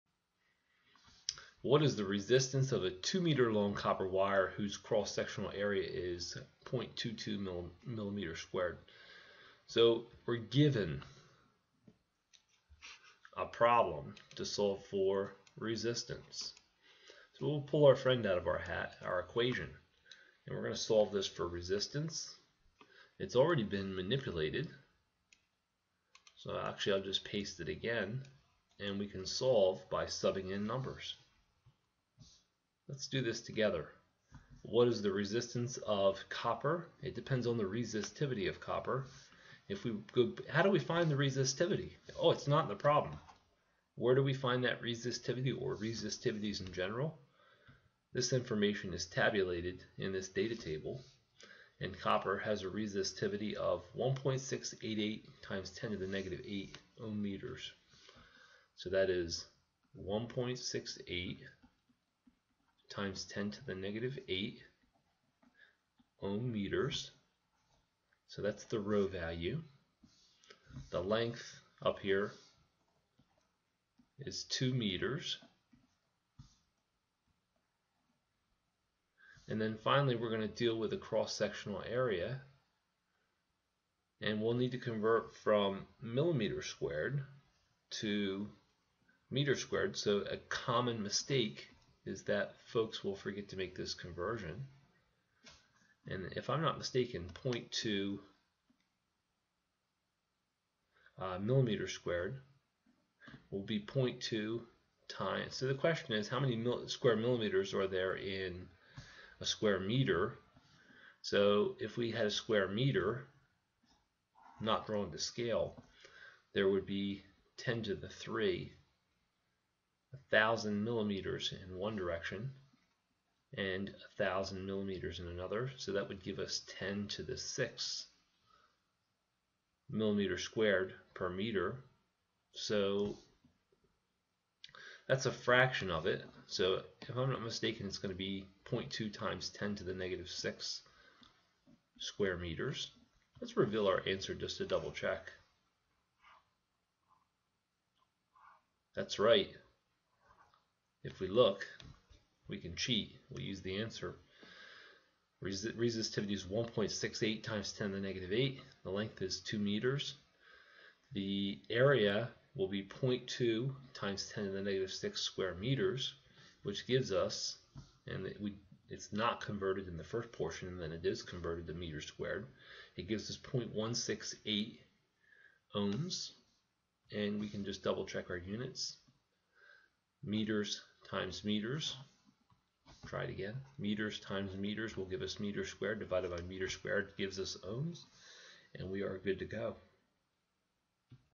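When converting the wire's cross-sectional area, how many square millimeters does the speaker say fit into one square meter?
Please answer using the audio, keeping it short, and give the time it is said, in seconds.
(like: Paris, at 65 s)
10^6, at 126 s.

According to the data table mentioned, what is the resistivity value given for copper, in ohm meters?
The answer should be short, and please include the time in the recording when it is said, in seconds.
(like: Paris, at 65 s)
1.688 × 10^-8 ohm meters, at 53 s.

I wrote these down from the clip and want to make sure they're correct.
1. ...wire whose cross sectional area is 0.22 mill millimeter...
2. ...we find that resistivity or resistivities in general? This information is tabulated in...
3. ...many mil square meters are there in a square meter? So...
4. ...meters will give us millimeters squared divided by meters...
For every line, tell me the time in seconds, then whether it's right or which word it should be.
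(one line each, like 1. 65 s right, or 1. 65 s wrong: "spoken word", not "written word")
1. 4 s right
2. 44 s right
3. 106 s wrong: "millimeters", not "meters"
4. 184 s wrong: "meters", not "millimeters".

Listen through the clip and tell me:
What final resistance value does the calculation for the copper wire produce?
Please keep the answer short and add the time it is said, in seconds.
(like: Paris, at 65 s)
0.168 ohms, at 173 s.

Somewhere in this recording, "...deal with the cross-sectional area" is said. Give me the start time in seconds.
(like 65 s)
80 s.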